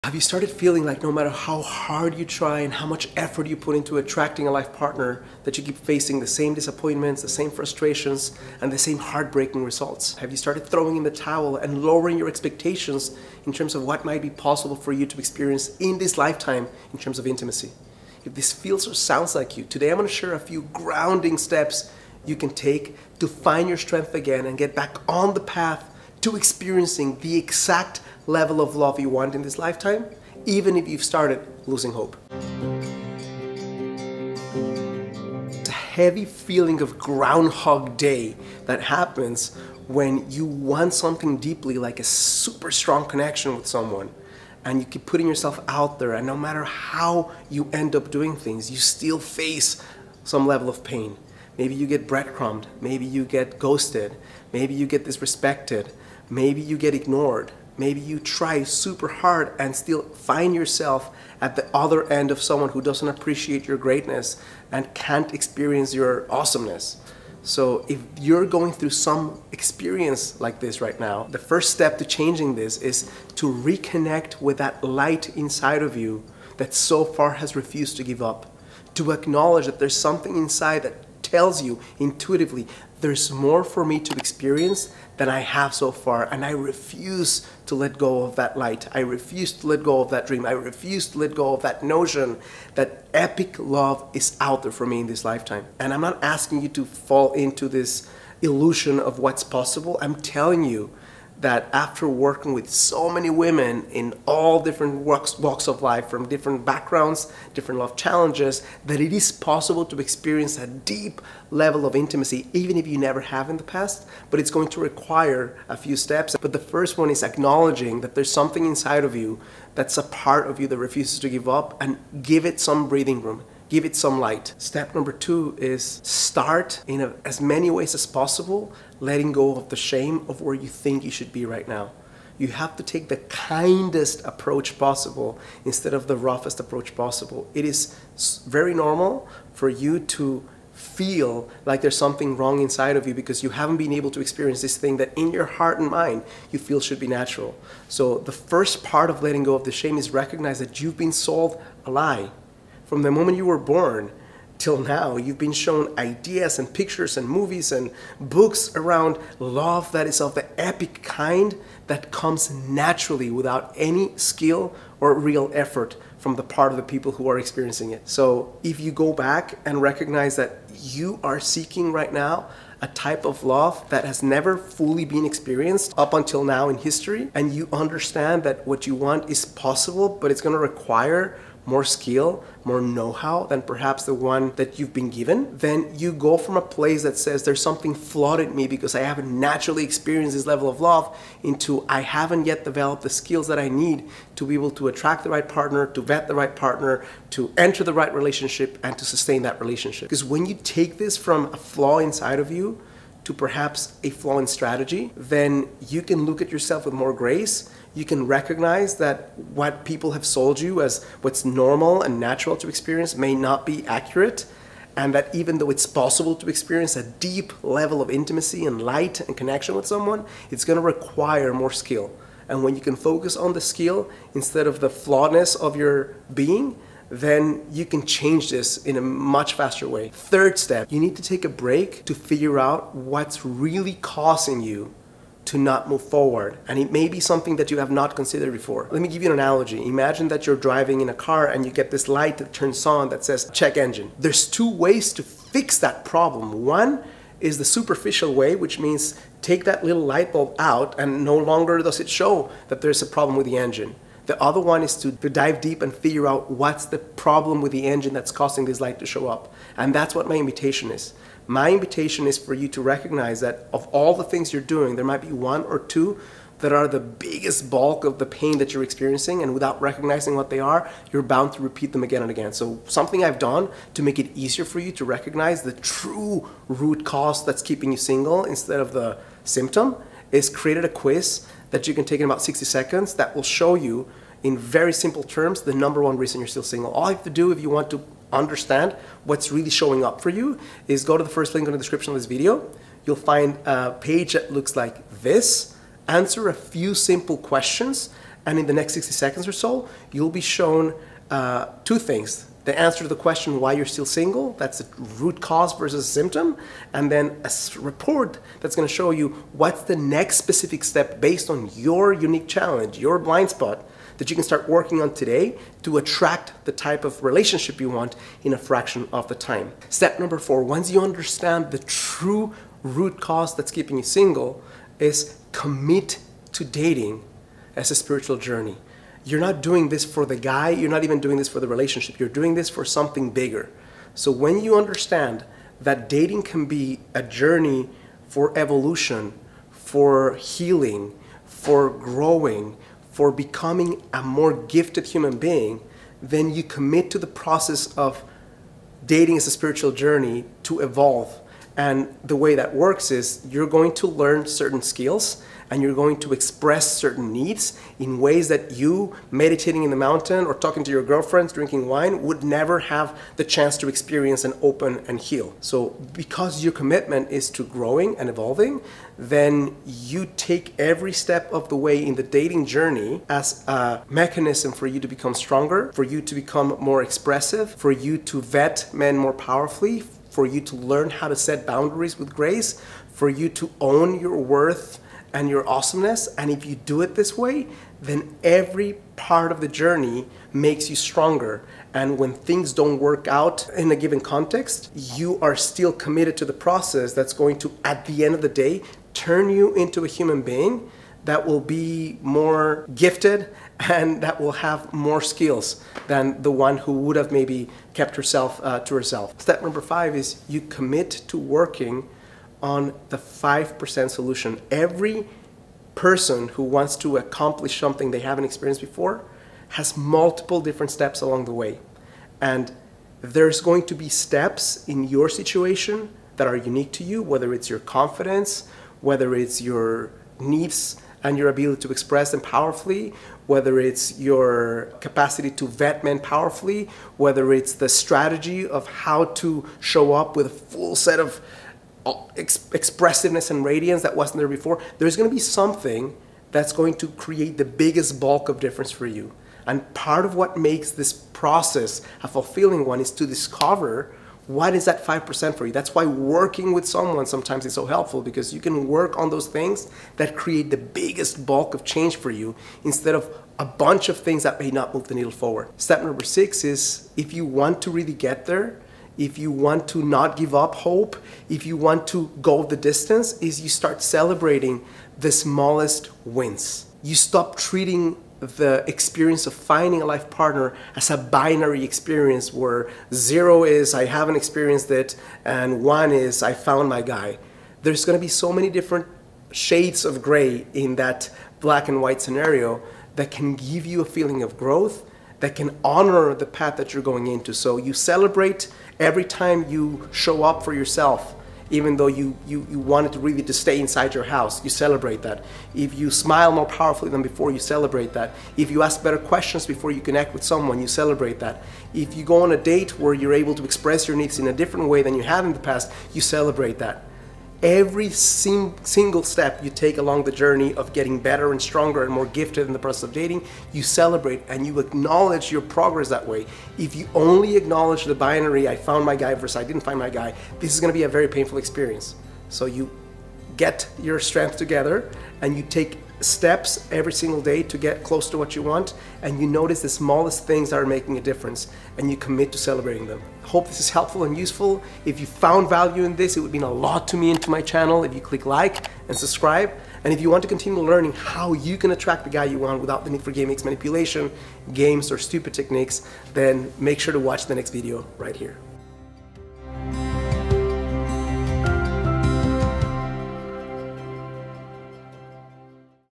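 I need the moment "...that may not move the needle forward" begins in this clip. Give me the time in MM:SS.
07:44.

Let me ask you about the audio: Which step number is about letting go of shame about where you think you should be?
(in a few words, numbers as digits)
2.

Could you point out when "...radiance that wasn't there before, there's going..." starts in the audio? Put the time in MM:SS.
07:23.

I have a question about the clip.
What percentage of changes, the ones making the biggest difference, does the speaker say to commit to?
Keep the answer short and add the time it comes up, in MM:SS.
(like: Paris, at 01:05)
5%, at 06:53.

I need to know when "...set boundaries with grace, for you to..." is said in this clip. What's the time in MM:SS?
06:21.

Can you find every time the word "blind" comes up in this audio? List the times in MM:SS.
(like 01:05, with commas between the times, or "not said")
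05:13.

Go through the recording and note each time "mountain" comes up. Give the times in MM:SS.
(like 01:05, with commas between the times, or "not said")
05:59.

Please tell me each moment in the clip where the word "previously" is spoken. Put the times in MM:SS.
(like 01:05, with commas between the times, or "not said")
not said.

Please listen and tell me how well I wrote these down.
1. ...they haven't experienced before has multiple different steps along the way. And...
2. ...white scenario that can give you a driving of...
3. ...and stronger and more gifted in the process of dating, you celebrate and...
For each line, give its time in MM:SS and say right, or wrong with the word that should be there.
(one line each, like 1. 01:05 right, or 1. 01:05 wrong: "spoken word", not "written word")
1. 06:58 right
2. 08:12 wrong: "feeling", not "driving"
3. 08:41 right.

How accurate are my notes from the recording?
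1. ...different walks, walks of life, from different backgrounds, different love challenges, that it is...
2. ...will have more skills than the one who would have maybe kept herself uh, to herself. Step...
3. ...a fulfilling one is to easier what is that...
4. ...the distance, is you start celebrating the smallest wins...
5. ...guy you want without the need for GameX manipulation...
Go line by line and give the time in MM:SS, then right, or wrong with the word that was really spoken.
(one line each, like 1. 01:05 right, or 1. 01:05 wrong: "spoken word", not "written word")
1. 01:44 right
2. 06:44 right
3. 07:32 wrong: "discover", not "easier"
4. 07:52 right
5. 09:12 right.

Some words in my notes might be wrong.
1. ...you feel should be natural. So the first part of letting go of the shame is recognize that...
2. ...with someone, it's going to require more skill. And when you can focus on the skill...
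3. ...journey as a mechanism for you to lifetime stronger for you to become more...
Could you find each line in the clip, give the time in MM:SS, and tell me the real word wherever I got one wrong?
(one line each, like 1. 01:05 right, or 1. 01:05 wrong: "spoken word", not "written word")
1. 02:26 right
2. 03:39 right
3. 06:12 wrong: "become", not "lifetime".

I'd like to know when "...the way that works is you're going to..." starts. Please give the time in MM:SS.
05:52.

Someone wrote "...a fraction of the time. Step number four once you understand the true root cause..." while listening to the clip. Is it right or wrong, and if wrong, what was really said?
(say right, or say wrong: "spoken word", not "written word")
right.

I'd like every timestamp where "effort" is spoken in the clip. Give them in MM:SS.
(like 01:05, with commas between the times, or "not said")
00:03, 02:45.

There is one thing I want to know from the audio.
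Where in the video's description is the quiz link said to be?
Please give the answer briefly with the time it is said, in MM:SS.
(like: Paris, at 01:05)
The first link, at 04:51.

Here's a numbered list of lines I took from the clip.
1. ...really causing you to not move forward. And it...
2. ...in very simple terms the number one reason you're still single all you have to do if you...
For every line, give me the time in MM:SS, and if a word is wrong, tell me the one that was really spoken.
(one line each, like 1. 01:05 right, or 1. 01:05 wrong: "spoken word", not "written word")
1. 03:53 right
2. 04:44 right.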